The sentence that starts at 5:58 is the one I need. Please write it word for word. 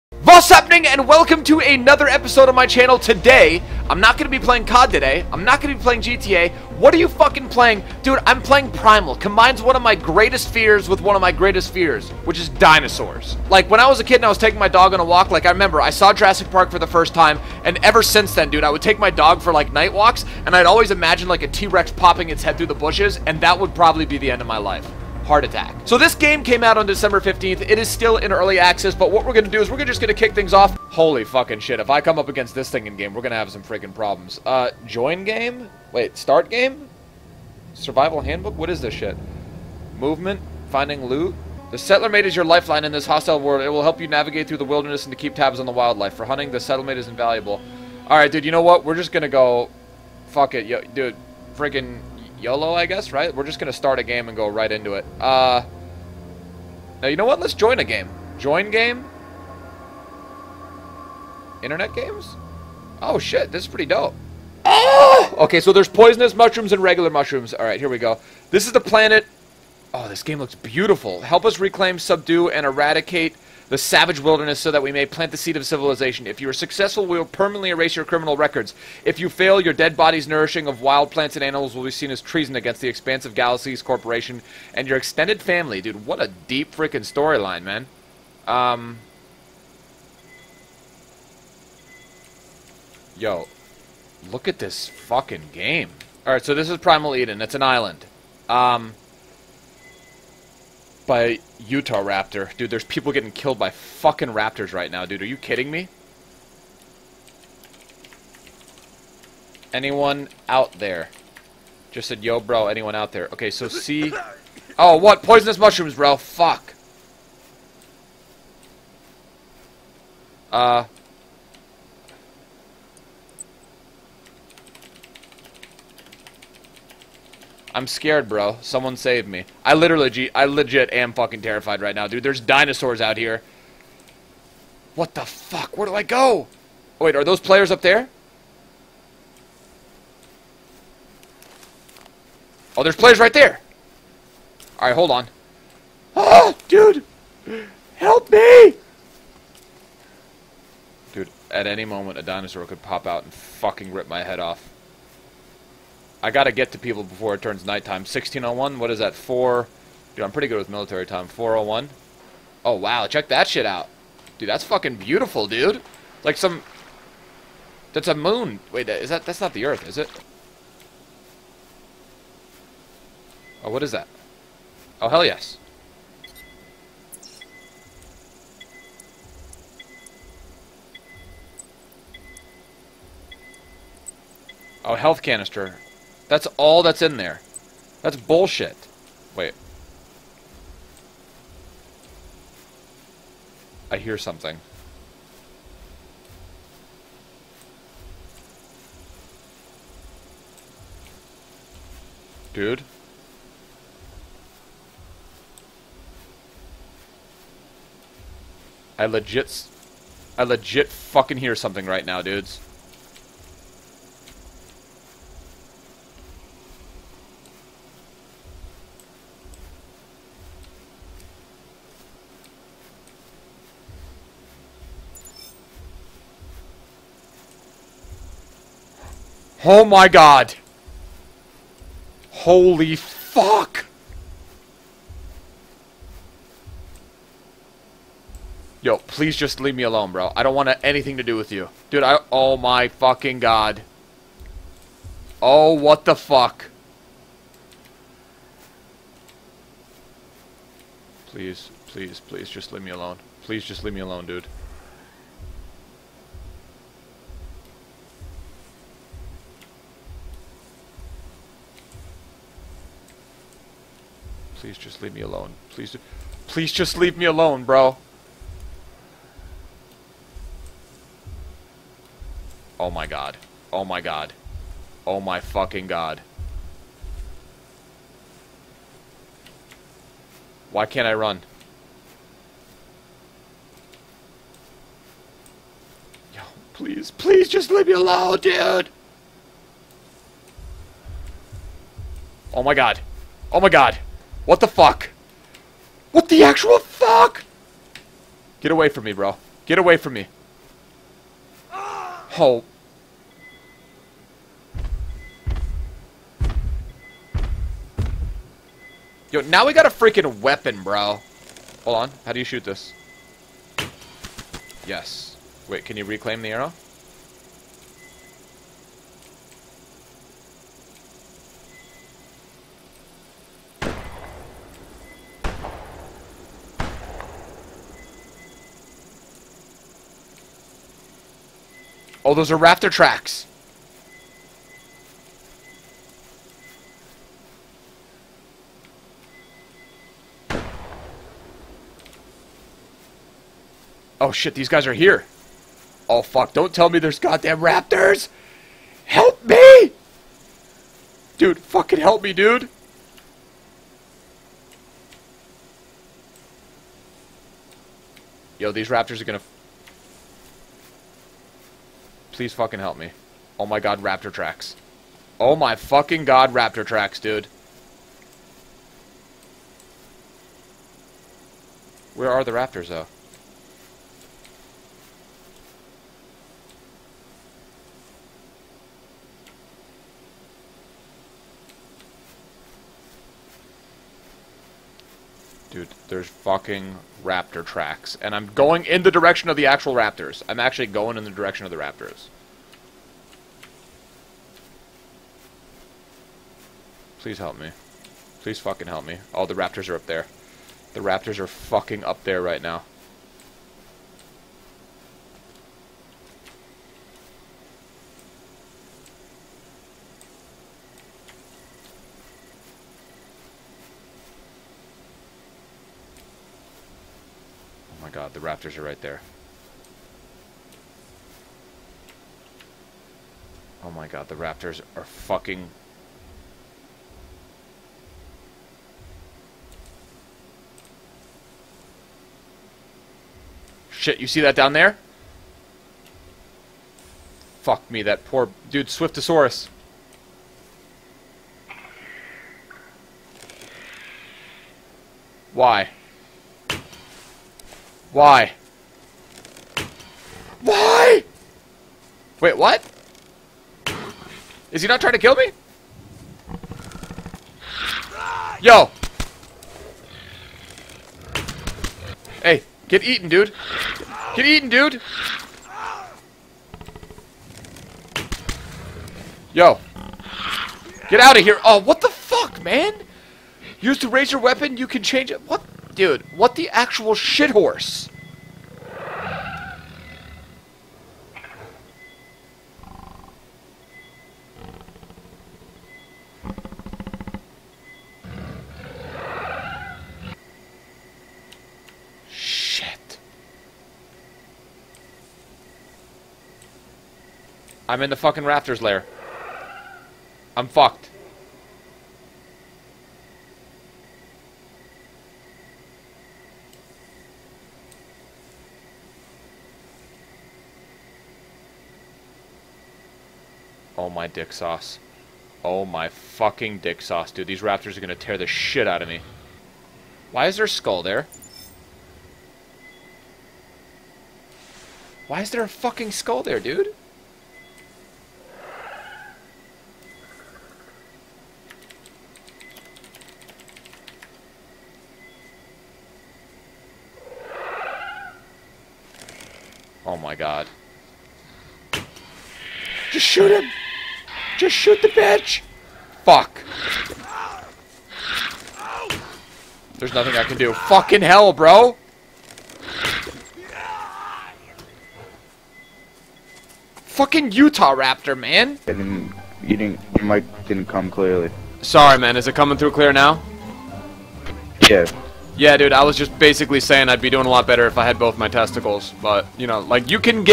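Yo, these raptors are gonna Please fucking help me.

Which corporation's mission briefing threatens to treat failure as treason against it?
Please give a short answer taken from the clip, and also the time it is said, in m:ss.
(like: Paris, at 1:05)
Expansive Galaxies Corporation, at 1:22.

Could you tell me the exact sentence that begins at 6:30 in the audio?
I'm actually going in the direction of the raptors.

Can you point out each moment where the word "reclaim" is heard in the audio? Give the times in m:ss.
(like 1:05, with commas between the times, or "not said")
1:11, 5:16.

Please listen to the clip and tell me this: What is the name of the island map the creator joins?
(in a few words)
Primal Eden.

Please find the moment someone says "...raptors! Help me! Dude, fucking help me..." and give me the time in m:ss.
5:47.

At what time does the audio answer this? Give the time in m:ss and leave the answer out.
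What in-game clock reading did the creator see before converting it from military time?
2:38.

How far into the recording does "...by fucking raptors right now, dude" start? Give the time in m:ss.
1:43.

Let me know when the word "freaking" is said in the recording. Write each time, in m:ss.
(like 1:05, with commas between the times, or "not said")
0:33, 0:51, 1:26, 5:09.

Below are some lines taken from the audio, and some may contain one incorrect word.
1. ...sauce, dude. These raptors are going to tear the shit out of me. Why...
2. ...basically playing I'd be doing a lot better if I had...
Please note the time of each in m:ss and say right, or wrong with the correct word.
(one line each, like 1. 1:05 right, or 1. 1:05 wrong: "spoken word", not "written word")
1. 8:37 right
2. 9:26 wrong: "saying", not "playing".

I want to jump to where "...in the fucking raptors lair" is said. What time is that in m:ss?
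8:18.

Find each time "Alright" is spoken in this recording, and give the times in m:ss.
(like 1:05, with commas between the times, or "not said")
1:36.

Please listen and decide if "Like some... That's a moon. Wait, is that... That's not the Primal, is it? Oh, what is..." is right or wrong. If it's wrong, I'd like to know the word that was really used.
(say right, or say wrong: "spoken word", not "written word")
wrong: "Earth", not "Primal".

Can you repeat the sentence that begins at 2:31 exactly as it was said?
Dude, at any moment, a dinosaur could pop out and fucking rip my head off.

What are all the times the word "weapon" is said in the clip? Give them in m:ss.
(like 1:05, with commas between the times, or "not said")
5:10, 7:54.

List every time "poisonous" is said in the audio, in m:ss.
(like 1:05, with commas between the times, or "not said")
1:05, 1:55.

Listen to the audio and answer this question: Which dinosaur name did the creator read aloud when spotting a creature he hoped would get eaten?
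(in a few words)
Swiftosaurus.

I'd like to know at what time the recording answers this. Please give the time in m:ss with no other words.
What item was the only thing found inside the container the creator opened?
3:04.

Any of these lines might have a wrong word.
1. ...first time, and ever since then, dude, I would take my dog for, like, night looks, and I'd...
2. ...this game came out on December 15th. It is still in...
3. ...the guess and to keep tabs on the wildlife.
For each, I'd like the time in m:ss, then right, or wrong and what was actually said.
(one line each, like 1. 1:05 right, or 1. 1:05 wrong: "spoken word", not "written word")
1. 0:16 wrong: "walks", not "looks"
2. 0:25 right
3. 0:44 wrong: "wilderness", not "guess".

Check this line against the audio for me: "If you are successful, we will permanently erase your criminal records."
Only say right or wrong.
right.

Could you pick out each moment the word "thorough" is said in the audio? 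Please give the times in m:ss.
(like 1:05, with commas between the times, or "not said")
not said.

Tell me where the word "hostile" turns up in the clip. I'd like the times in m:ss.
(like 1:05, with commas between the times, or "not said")
0:43.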